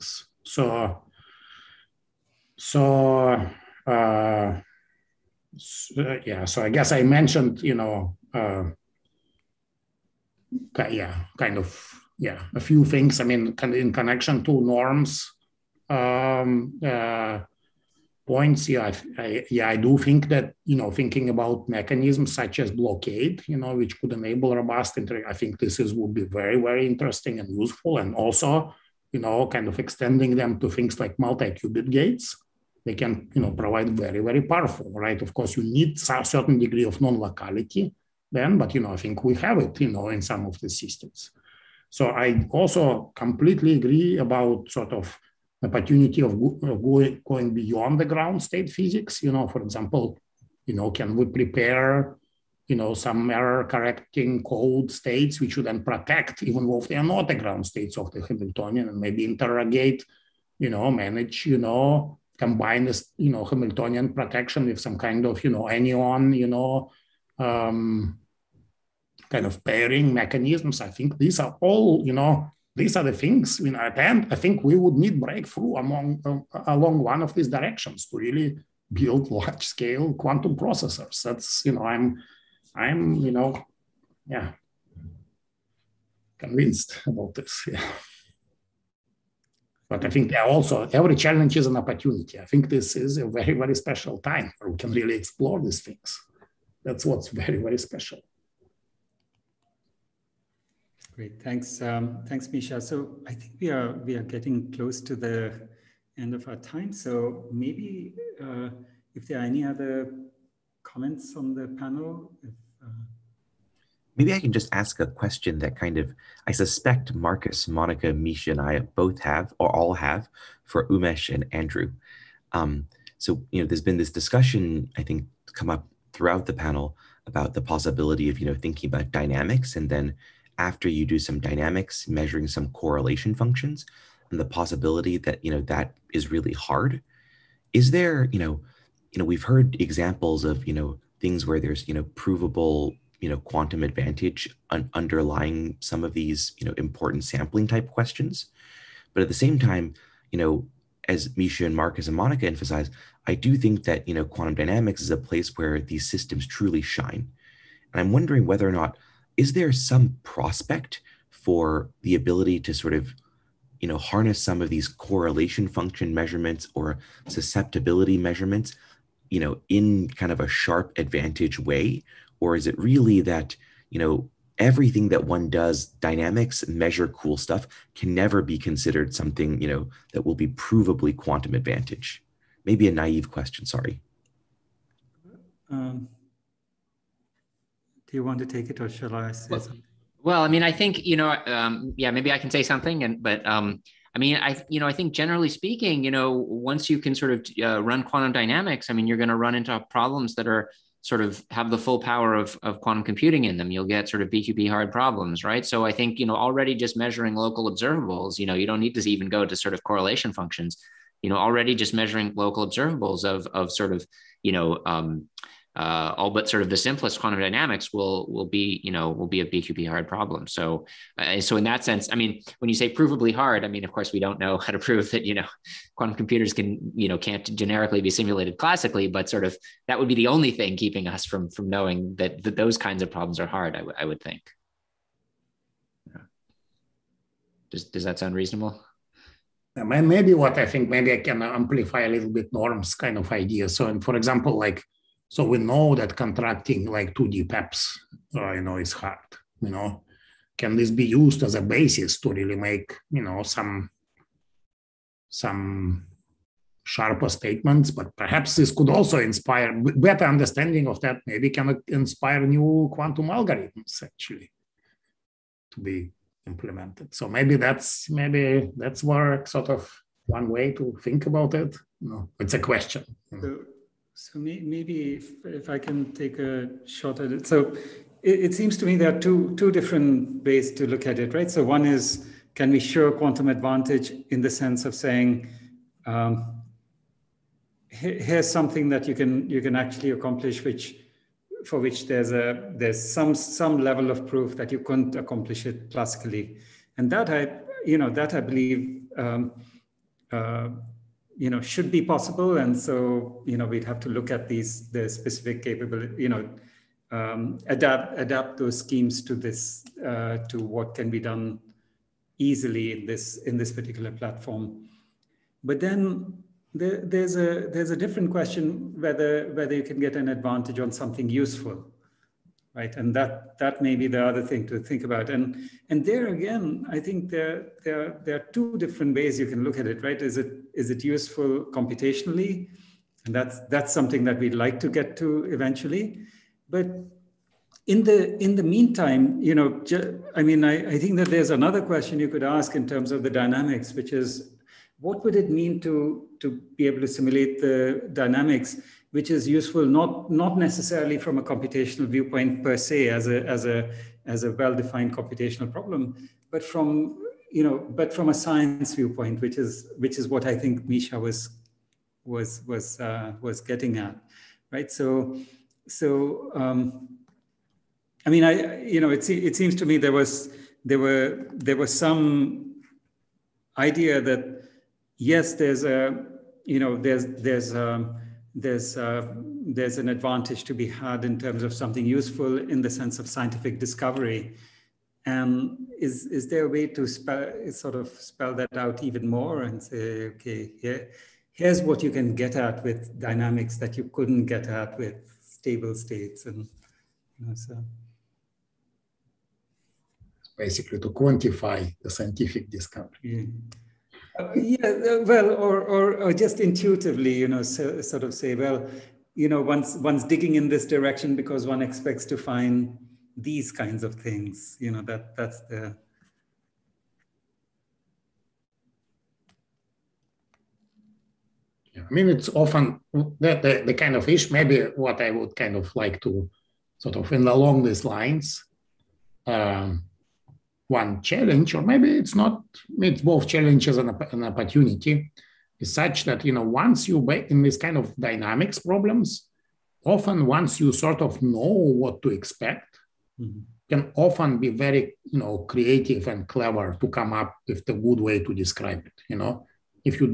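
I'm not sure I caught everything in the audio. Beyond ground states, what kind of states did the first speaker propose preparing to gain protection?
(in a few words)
Error correcting code states.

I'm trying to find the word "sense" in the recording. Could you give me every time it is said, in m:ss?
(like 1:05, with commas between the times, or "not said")
3:41, 4:44, 6:22.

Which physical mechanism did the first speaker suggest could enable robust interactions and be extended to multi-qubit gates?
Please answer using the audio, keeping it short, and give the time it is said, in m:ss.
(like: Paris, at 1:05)
Blockade, at 0:22.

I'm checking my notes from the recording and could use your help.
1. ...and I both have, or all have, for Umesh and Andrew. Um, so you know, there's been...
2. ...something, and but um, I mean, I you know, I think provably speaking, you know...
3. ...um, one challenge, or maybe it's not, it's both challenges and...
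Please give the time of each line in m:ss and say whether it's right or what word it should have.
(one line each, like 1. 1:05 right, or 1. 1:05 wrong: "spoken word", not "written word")
1. 1:58 right
2. 3:12 wrong: "generally", not "provably"
3. 7:09 right.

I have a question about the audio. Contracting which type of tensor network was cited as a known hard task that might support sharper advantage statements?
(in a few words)
2D PEPS.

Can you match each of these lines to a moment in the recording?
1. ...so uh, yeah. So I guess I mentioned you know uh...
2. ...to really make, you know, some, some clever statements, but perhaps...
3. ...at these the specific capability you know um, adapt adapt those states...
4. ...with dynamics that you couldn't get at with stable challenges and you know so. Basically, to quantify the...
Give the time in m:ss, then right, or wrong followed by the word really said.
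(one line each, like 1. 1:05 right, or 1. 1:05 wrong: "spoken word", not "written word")
1. 0:05 right
2. 4:12 wrong: "sharper", not "clever"
3. 5:04 wrong: "schemes", not "states"
4. 6:32 wrong: "states", not "challenges".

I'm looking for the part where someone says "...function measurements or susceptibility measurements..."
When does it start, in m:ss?
2:45.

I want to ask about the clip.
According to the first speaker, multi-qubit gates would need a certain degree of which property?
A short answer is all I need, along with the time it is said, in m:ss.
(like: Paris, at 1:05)
Non-locality, at 0:37.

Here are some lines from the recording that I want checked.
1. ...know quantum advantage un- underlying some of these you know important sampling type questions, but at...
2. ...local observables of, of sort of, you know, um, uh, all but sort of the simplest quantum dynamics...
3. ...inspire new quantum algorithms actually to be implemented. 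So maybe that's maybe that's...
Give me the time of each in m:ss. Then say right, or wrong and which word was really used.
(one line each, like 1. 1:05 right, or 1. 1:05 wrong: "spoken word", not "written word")
1. 2:23 right
2. 3:32 right
3. 4:21 right.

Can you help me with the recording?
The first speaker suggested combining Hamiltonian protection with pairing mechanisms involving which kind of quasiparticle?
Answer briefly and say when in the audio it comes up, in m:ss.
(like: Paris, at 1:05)
Anyon, at 1:05.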